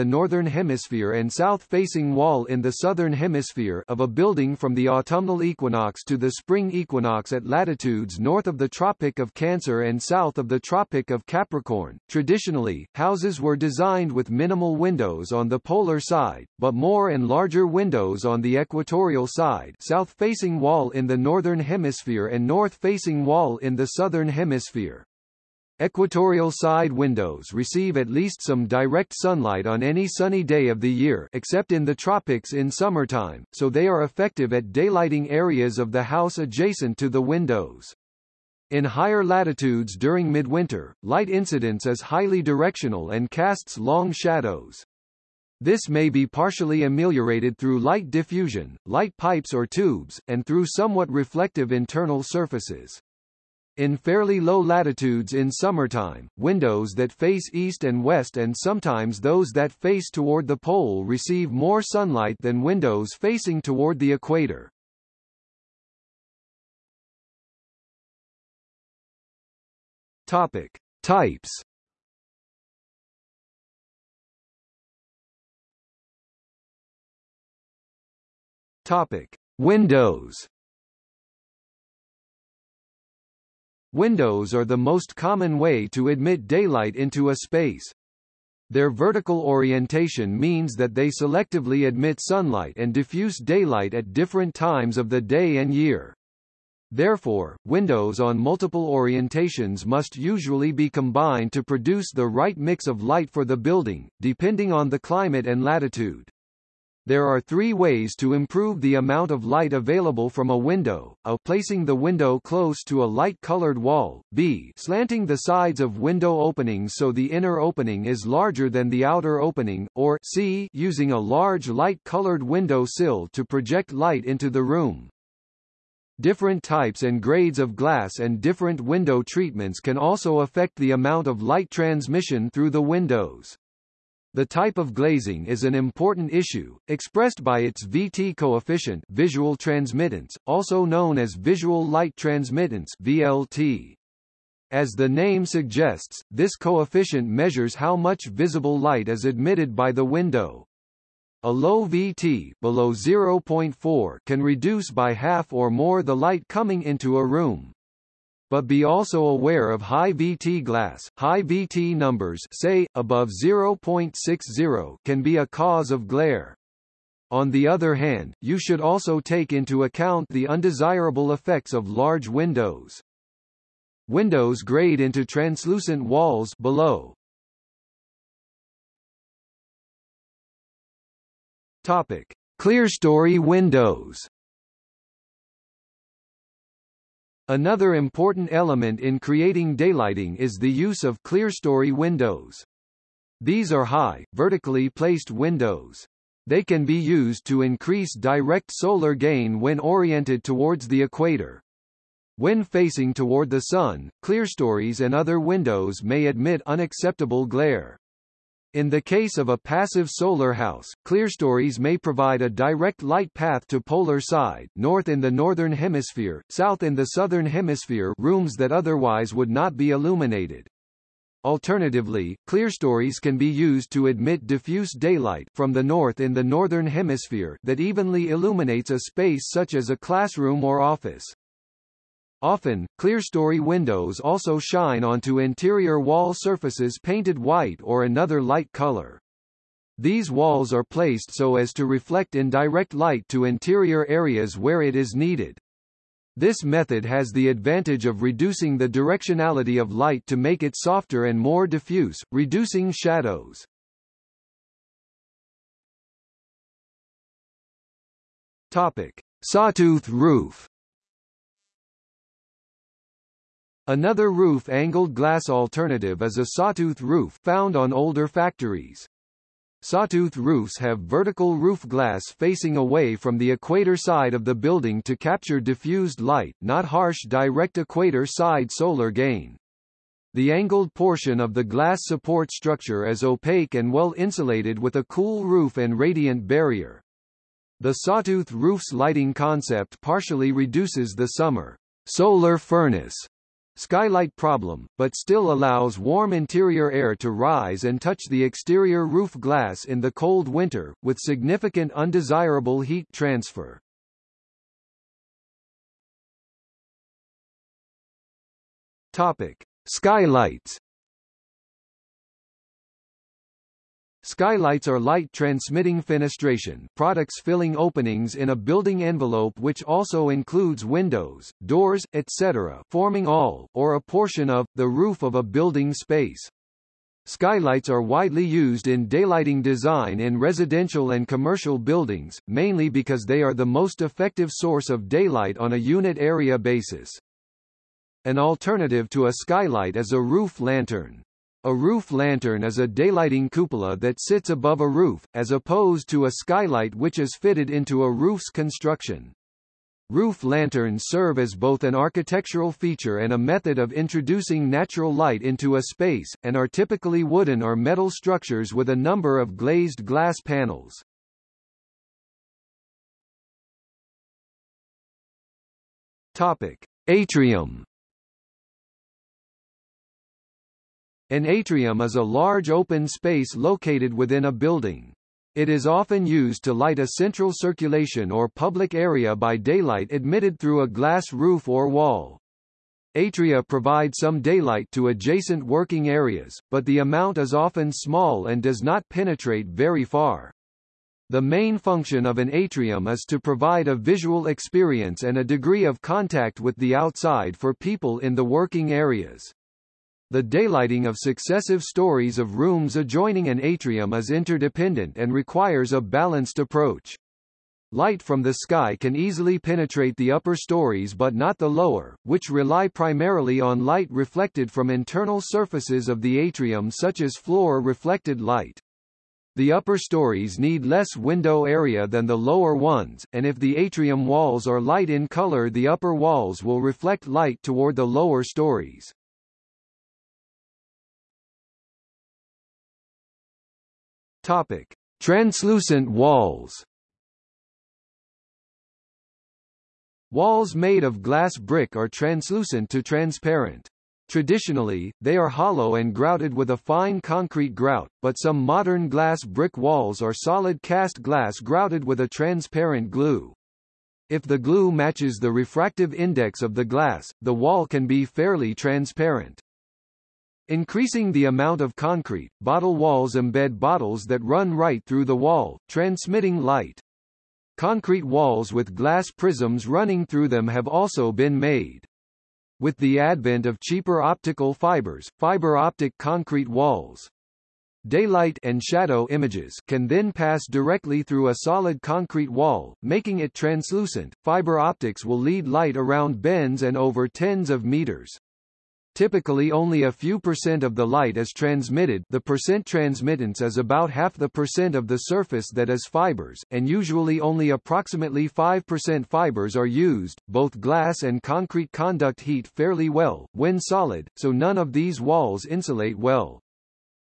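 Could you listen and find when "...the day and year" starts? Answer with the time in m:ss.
1:35.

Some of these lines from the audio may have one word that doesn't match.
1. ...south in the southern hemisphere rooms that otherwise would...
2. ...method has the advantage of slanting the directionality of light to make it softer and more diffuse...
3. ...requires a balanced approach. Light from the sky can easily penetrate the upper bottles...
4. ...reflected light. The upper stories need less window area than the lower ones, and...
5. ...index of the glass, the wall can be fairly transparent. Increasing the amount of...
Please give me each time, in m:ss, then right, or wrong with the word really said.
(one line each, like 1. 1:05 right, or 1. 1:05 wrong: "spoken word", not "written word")
1. 3:36 right
2. 4:06 wrong: "reducing", not "slanting"
3. 6:45 wrong: "stories", not "bottles"
4. 6:57 right
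5. 7:36 right.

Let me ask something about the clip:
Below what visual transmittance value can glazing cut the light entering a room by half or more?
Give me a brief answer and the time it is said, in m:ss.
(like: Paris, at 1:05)
0.4, at 2:32.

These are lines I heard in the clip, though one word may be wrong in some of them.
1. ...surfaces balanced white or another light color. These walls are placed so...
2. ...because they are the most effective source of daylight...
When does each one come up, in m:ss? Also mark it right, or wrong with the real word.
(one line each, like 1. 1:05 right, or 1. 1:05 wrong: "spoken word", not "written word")
1. 3:56 wrong: "painted", not "balanced"
2. 5:32 right.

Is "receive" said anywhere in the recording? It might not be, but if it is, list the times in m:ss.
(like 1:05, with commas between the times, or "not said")
0:27, 1:01.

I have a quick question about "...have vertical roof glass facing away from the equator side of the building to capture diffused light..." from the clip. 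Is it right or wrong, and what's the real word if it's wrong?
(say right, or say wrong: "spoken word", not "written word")
right.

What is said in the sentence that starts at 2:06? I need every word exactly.
Different types and grades of glass and different window treatments can also affect the amount of light transmission through the windows.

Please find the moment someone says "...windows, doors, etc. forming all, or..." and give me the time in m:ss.
5:20.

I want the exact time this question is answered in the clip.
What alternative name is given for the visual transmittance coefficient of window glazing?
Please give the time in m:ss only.
2:21.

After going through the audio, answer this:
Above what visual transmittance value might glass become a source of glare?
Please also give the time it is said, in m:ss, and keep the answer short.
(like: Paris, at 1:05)
0.60, at 2:42.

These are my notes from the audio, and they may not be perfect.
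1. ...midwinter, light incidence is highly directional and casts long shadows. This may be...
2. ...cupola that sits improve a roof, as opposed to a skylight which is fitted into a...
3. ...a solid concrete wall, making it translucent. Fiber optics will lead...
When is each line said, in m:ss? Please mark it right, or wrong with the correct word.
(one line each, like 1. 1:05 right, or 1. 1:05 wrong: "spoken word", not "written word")
1. 0:40 right
2. 5:43 wrong: "above", not "improve"
3. 8:01 right.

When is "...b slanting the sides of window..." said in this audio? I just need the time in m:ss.
1:54.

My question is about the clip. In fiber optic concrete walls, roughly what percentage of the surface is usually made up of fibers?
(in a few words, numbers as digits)
5%.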